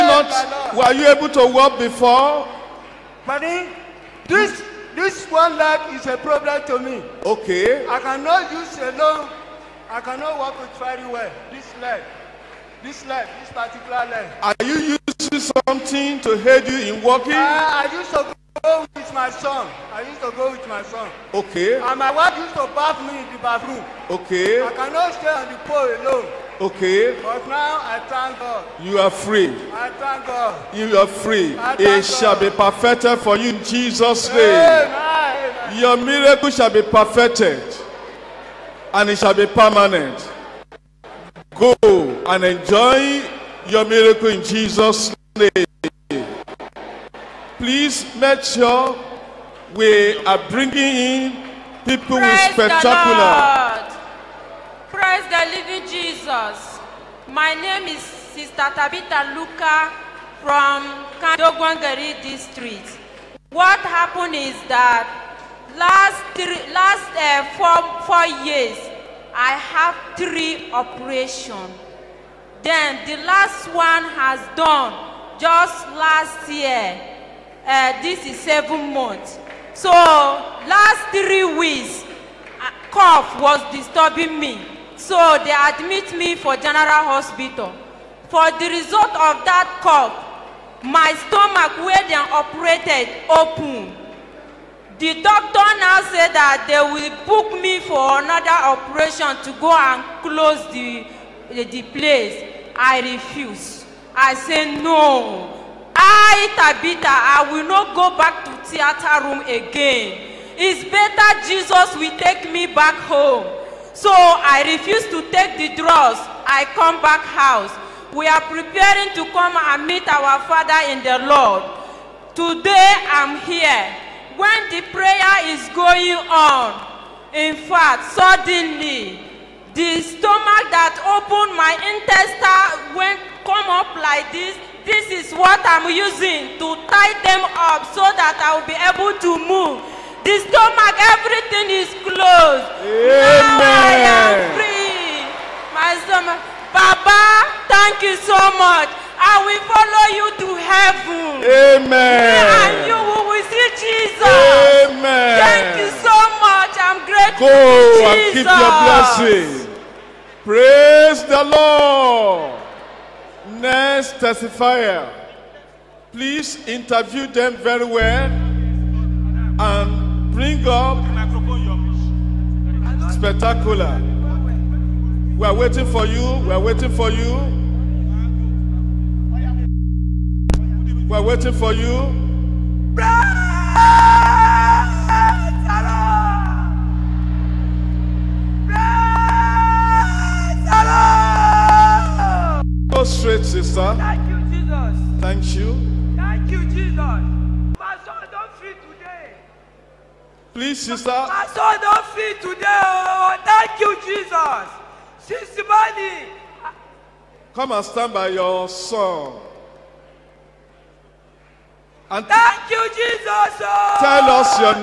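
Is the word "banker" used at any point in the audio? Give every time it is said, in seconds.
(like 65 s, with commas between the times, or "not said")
not said.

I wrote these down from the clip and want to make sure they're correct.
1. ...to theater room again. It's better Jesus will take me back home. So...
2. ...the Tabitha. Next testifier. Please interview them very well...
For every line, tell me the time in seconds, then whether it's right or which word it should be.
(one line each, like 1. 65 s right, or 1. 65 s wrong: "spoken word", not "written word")
1. 108 s right
2. 161 s wrong: "Lord", not "Tabitha".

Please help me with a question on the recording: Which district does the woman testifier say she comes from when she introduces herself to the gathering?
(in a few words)
Kandogwangari.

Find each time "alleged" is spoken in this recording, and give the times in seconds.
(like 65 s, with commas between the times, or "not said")
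not said.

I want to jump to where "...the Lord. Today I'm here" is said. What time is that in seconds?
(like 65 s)
121 s.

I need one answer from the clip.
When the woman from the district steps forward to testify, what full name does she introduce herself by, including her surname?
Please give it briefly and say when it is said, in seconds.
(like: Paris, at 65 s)
Tabitha Luca, at 58 s.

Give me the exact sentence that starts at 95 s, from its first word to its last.
The doctor now said that they will book me for another operation to go and close the, the, the place.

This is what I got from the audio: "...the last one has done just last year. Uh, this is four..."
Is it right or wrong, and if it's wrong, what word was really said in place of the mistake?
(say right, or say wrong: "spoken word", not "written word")
wrong: "seven", not "four".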